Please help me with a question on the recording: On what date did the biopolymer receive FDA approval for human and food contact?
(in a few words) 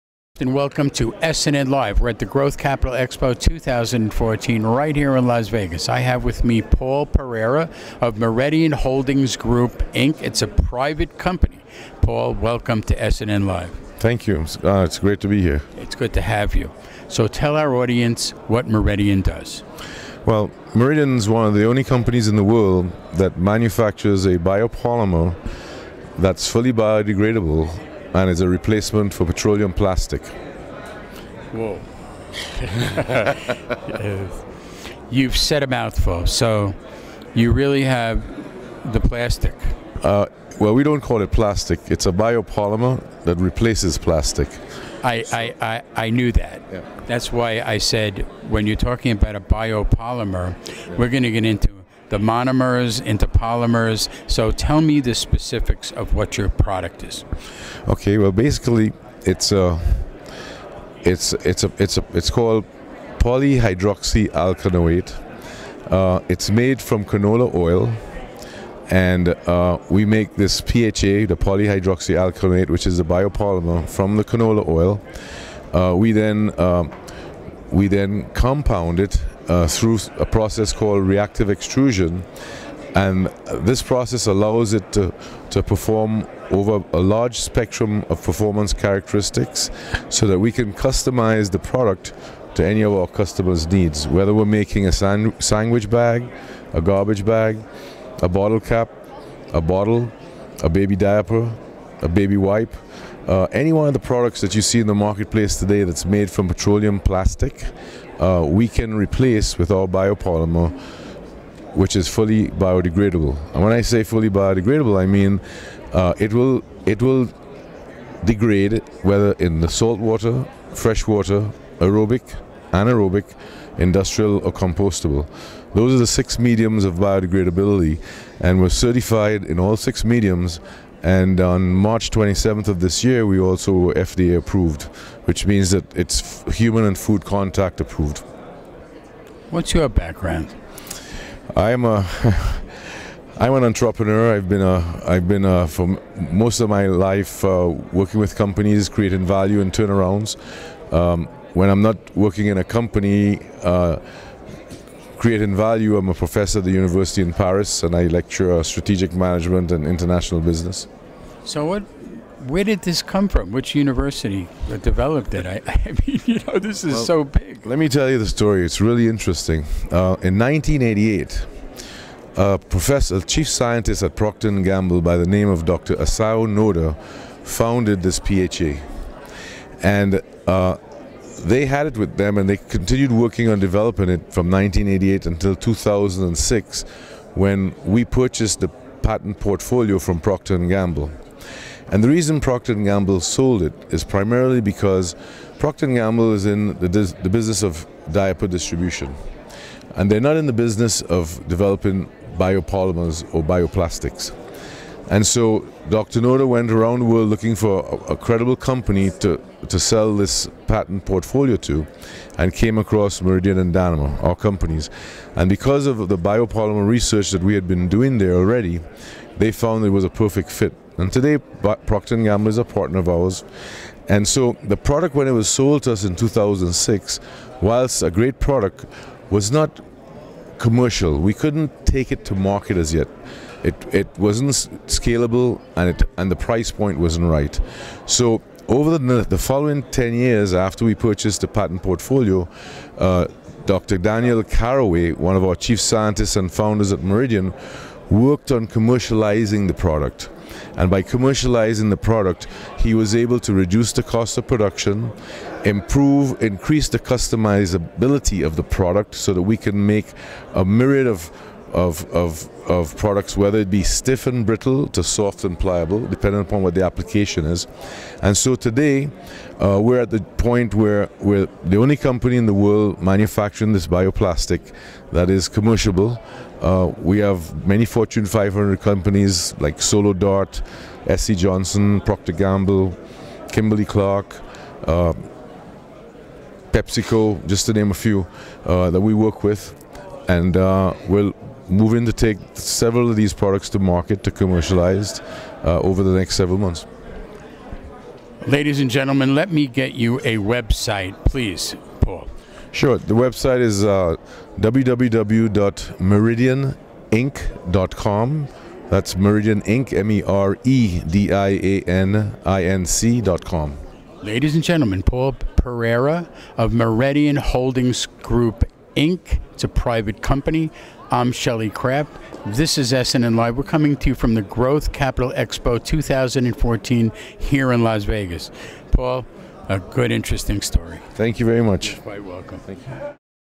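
March 27.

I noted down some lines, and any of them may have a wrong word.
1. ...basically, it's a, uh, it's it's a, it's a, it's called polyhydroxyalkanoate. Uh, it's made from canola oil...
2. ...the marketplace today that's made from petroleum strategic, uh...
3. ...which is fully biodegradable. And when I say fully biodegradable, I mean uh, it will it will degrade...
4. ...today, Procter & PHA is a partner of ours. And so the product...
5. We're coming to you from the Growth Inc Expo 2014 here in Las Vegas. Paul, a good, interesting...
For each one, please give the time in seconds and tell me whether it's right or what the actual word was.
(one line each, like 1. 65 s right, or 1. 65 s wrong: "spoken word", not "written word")
1. 58 s right
2. 104 s wrong: "plastic", not "strategic"
3. 111 s right
4. 221 s wrong: "Gamble", not "PHA"
5. 323 s wrong: "Capital", not "Inc".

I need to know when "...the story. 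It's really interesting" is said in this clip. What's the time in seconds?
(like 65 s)
168 s.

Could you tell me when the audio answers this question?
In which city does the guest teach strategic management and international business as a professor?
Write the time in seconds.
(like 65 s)
157 s.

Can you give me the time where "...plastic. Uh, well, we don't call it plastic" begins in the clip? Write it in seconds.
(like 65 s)
38 s.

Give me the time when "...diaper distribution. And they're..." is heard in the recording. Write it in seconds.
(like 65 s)
198 s.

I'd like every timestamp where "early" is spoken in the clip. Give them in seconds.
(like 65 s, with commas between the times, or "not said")
not said.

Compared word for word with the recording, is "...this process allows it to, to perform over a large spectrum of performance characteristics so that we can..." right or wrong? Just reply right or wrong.
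right.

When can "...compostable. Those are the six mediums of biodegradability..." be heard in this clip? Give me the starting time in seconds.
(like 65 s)
124 s.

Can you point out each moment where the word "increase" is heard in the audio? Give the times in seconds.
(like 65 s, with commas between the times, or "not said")
256 s.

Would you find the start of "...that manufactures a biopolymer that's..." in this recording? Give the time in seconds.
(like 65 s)
23 s.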